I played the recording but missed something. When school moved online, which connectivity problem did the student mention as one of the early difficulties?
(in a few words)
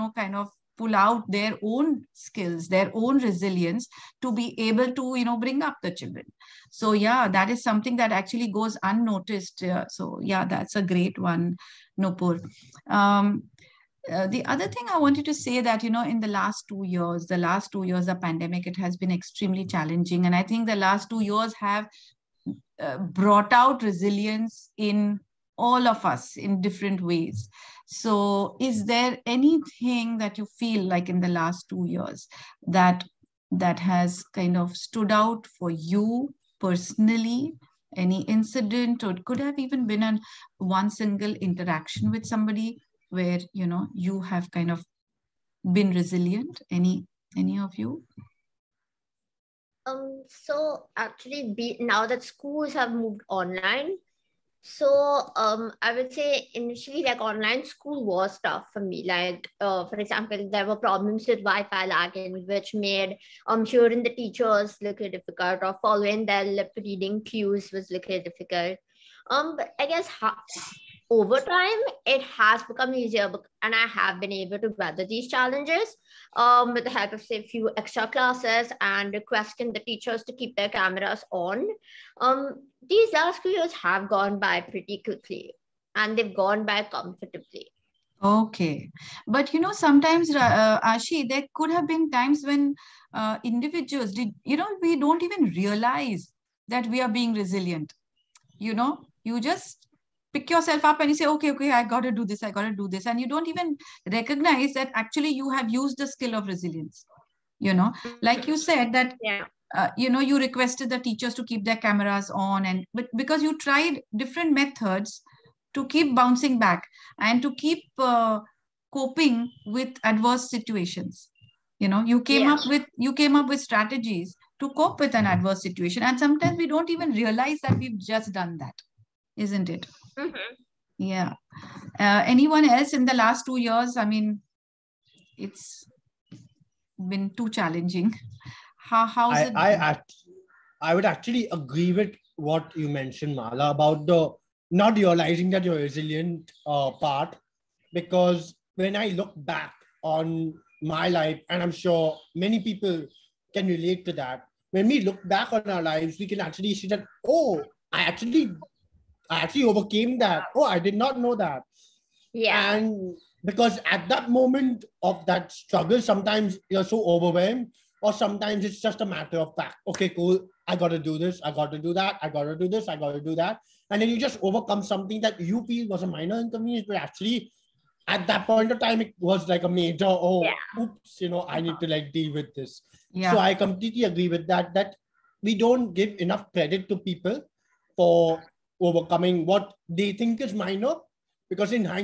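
Wi-fi lagging.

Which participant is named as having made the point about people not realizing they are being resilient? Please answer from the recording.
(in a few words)
Mala.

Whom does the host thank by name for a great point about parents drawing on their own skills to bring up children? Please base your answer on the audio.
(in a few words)
Nupur.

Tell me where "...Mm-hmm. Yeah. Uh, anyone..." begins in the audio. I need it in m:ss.
2:10.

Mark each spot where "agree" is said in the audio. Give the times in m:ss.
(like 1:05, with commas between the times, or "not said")
2:21, 3:04.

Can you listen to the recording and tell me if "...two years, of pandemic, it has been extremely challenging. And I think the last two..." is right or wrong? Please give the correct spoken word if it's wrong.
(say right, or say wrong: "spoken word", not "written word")
right.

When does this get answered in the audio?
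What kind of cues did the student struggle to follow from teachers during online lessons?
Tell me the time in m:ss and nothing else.
1:06.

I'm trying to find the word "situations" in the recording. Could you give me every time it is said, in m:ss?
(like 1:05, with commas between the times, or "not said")
2:00, 2:05.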